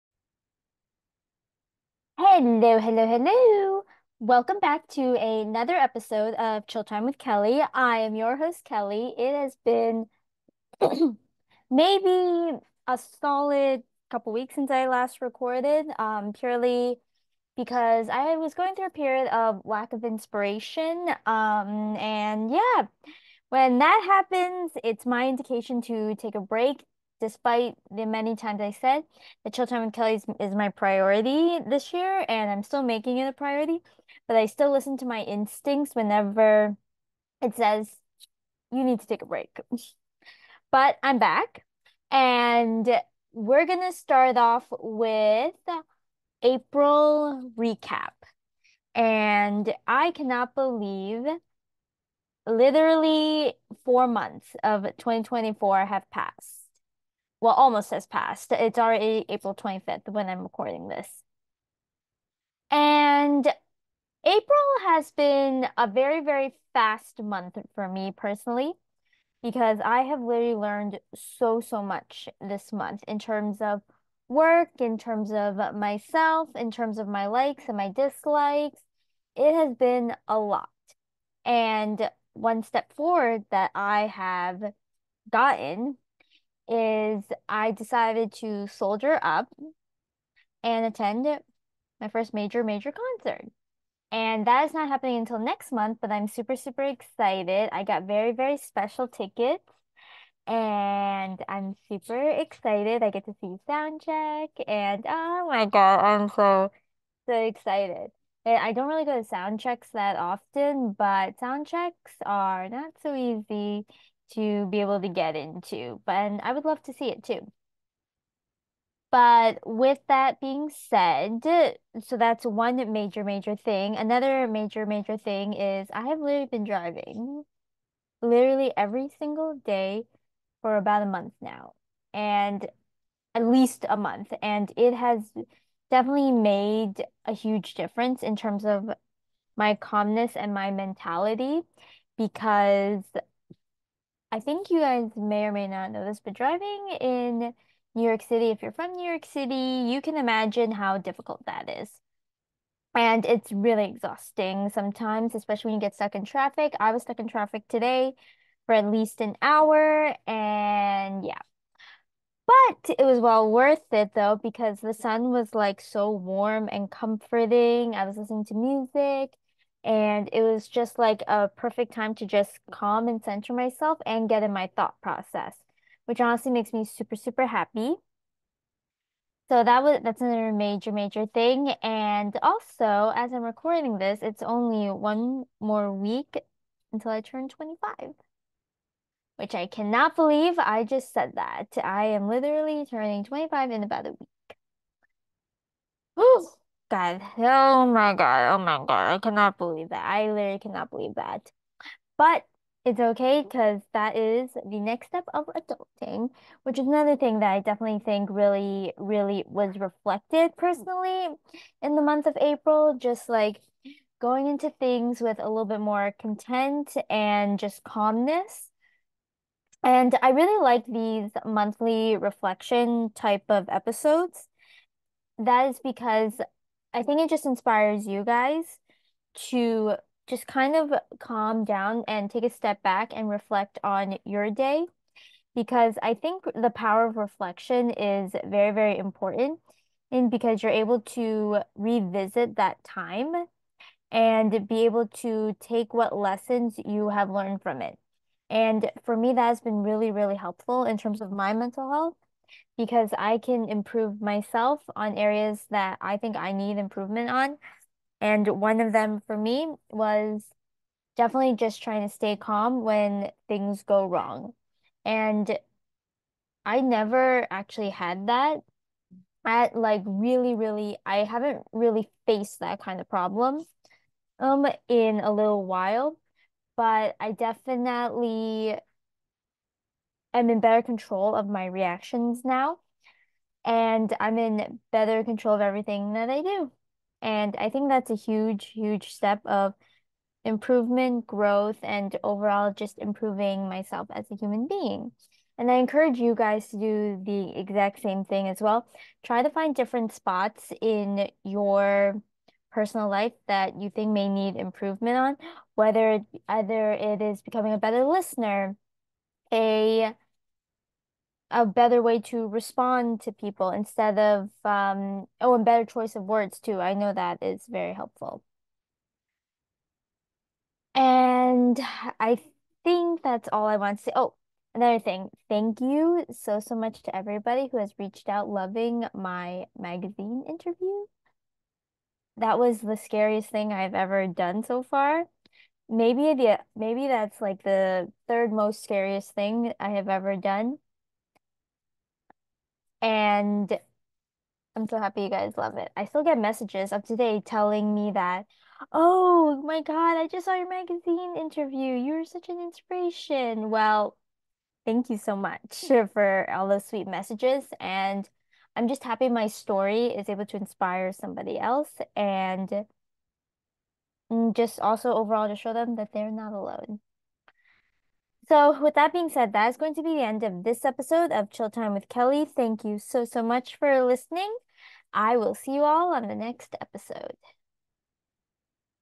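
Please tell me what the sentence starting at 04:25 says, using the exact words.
And I never actually had that.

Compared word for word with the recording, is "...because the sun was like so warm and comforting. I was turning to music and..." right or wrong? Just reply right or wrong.
wrong.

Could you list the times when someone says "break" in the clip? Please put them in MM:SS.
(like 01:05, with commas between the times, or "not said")
00:26, 00:39.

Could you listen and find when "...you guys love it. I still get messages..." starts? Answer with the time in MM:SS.
05:45.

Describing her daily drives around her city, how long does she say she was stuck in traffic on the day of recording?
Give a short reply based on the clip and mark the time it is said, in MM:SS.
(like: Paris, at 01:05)
at least an hour, at 02:39.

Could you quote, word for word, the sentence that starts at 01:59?
But with that being said, so that's one major, major thing.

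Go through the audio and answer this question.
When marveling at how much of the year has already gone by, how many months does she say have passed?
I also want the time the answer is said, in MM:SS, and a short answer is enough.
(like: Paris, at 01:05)
4, at 00:53.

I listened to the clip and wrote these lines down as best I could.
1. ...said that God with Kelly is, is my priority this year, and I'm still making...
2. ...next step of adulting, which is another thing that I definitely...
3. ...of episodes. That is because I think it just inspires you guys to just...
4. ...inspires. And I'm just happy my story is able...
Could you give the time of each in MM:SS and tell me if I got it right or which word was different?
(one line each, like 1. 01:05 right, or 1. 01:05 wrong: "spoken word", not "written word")
1. 00:28 wrong: "Time", not "God"
2. 03:24 right
3. 03:43 right
4. 05:57 wrong: "messages", not "inspires".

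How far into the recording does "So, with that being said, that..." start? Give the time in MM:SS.
06:08.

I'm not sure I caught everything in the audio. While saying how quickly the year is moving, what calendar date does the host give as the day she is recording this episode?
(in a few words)
April 25th.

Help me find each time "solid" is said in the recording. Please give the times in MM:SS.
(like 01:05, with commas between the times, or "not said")
00:13.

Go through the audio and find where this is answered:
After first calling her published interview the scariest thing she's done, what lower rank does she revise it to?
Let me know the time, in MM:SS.
05:38.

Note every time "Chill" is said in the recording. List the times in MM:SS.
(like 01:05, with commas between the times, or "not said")
00:06, 06:11.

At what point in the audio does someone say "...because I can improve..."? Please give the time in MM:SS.
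04:12.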